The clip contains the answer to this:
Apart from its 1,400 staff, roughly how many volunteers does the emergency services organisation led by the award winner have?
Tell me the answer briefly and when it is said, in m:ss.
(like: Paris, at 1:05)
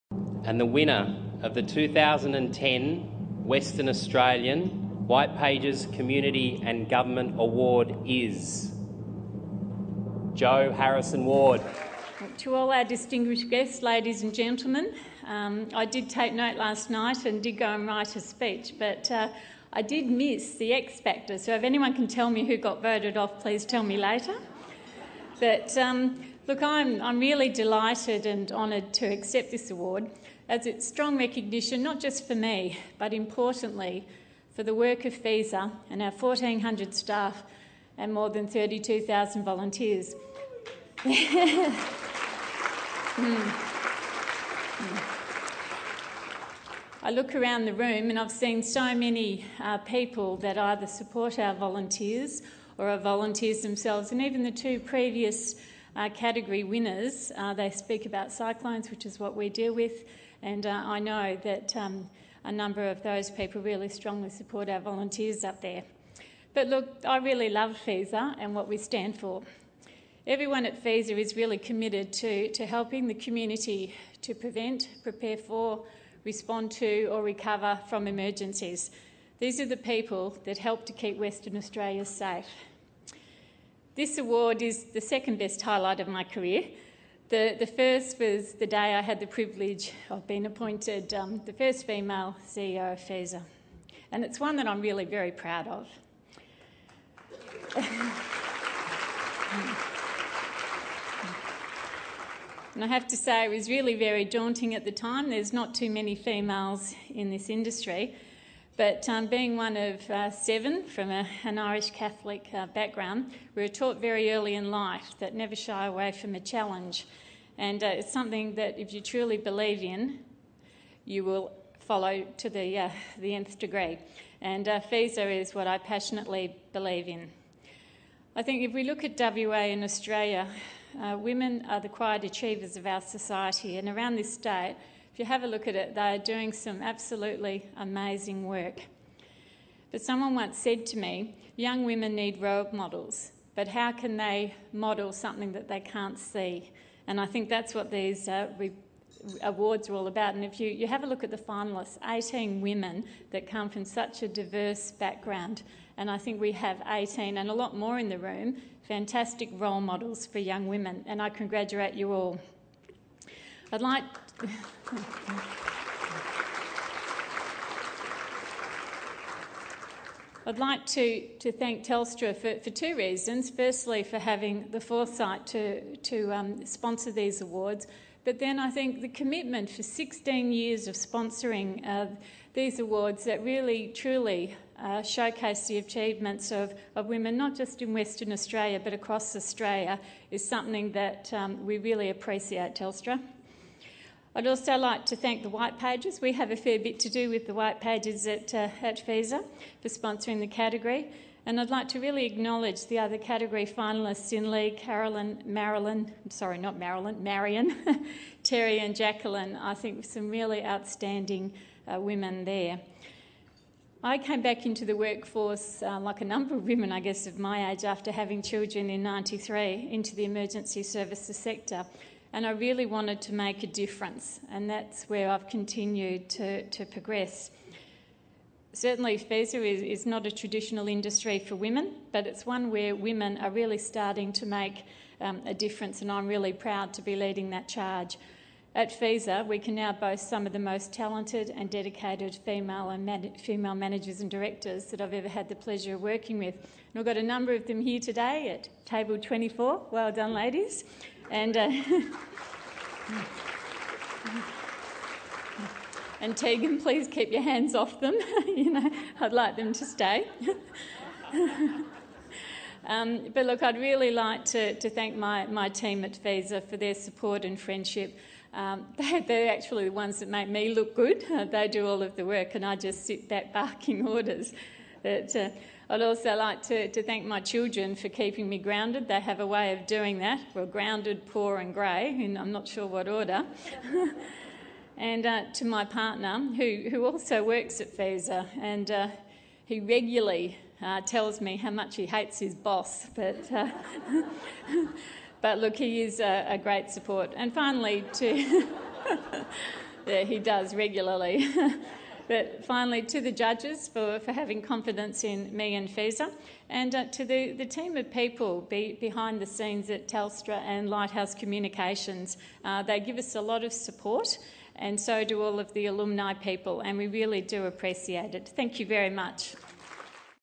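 32,000, at 0:38.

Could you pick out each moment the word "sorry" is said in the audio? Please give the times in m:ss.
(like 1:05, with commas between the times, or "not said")
3:26.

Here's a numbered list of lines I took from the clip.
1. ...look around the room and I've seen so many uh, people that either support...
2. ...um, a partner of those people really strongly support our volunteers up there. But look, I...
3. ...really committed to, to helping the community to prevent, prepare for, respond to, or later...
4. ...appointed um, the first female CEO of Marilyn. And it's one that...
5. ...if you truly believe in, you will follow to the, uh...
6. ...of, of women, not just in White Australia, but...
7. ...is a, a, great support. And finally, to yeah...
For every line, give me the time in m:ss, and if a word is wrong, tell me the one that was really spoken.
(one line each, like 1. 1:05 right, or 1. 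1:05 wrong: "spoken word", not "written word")
1. 0:47 right
2. 1:01 wrong: "number", not "partner"
3. 1:11 wrong: "recover", not "later"
4. 1:30 wrong: "FESA", not "Marilyn"
5. 1:58 right
6. 3:06 wrong: "Western", not "White"
7. 4:56 right.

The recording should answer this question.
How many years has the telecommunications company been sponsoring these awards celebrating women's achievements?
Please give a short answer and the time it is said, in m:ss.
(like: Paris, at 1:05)
16, at 2:59.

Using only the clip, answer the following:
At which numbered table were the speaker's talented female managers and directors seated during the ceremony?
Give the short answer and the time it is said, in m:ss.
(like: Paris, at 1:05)
24, at 4:08.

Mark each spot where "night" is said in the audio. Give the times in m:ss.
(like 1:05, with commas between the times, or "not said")
0:16.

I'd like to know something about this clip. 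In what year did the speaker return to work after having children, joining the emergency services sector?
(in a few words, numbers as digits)
1993.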